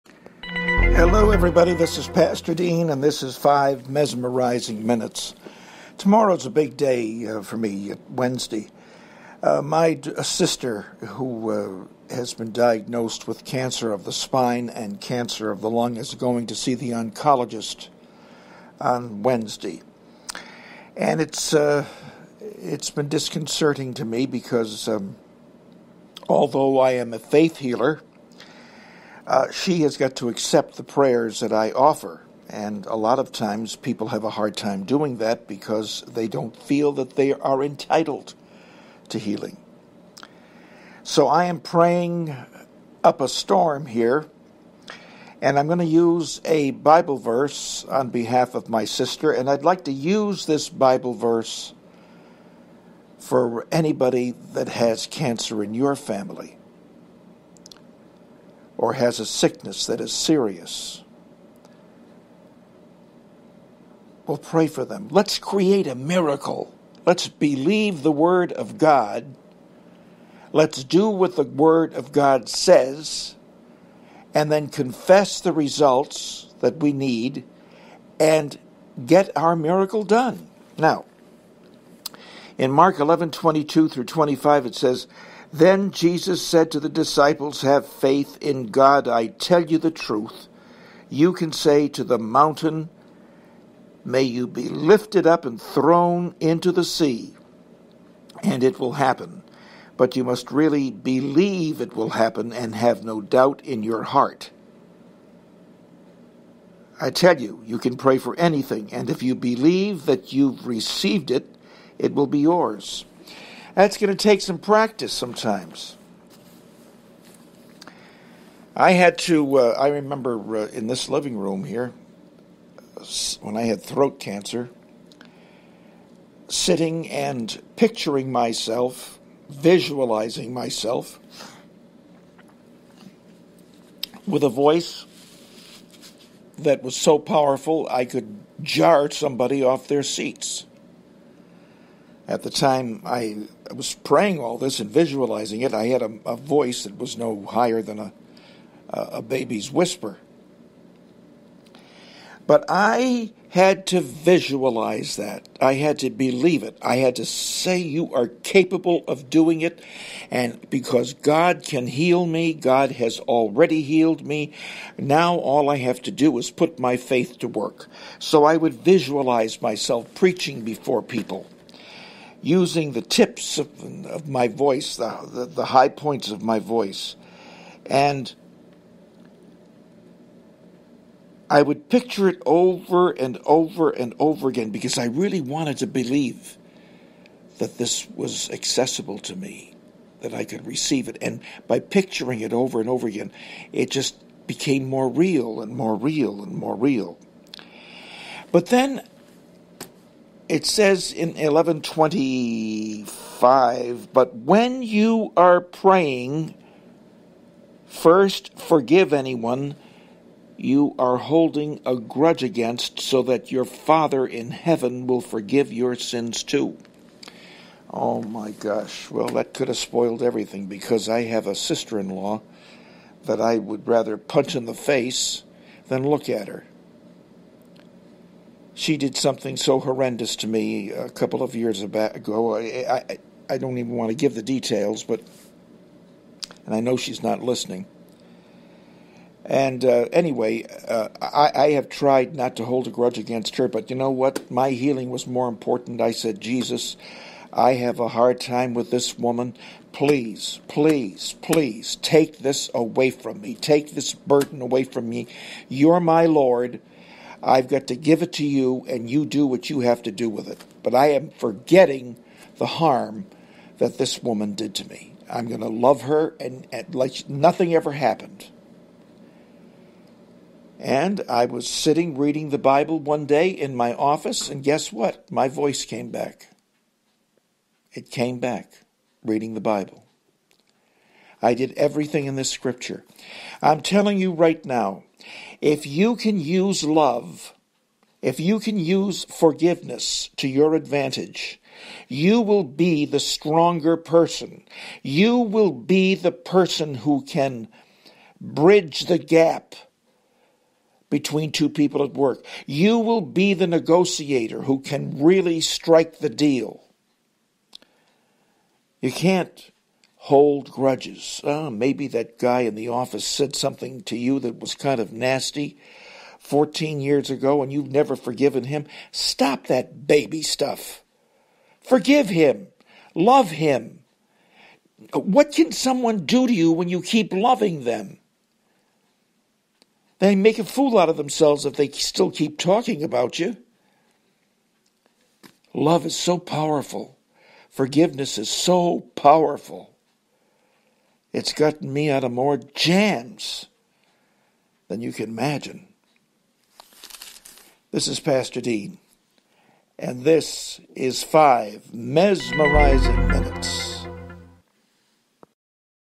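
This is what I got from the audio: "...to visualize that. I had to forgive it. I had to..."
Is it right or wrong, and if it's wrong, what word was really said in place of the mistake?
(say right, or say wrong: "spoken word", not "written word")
wrong: "believe", not "forgive".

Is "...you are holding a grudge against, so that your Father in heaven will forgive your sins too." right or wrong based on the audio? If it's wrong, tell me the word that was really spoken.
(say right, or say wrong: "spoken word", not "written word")
right.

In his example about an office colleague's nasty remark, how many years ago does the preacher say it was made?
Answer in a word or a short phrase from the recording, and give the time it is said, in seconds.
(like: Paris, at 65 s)
14, at 316 s.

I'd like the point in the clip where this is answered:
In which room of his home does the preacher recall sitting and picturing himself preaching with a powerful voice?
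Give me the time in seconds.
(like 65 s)
121 s.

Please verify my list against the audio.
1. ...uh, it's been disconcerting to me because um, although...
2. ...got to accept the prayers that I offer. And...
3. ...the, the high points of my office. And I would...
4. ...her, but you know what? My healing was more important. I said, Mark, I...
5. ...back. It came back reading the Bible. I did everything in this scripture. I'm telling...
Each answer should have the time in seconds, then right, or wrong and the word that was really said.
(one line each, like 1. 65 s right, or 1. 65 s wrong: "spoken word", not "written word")
1. 21 s right
2. 29 s right
3. 175 s wrong: "voice", not "office"
4. 243 s wrong: "Jesus", not "Mark"
5. 276 s right.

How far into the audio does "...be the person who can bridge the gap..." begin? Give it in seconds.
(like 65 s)
295 s.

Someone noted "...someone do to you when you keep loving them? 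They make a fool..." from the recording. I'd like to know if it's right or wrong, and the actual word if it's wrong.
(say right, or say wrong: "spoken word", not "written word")
right.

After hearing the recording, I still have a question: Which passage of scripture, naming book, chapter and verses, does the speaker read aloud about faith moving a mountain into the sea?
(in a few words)
Mark 11:22-25.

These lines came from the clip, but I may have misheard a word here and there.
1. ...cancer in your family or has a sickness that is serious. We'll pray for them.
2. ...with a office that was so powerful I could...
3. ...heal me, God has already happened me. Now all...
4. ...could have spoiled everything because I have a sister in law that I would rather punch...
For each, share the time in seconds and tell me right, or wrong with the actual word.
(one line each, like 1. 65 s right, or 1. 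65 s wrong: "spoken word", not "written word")
1. 55 s right
2. 134 s wrong: "voice", not "office"
3. 161 s wrong: "healed", not "happened"
4. 219 s right.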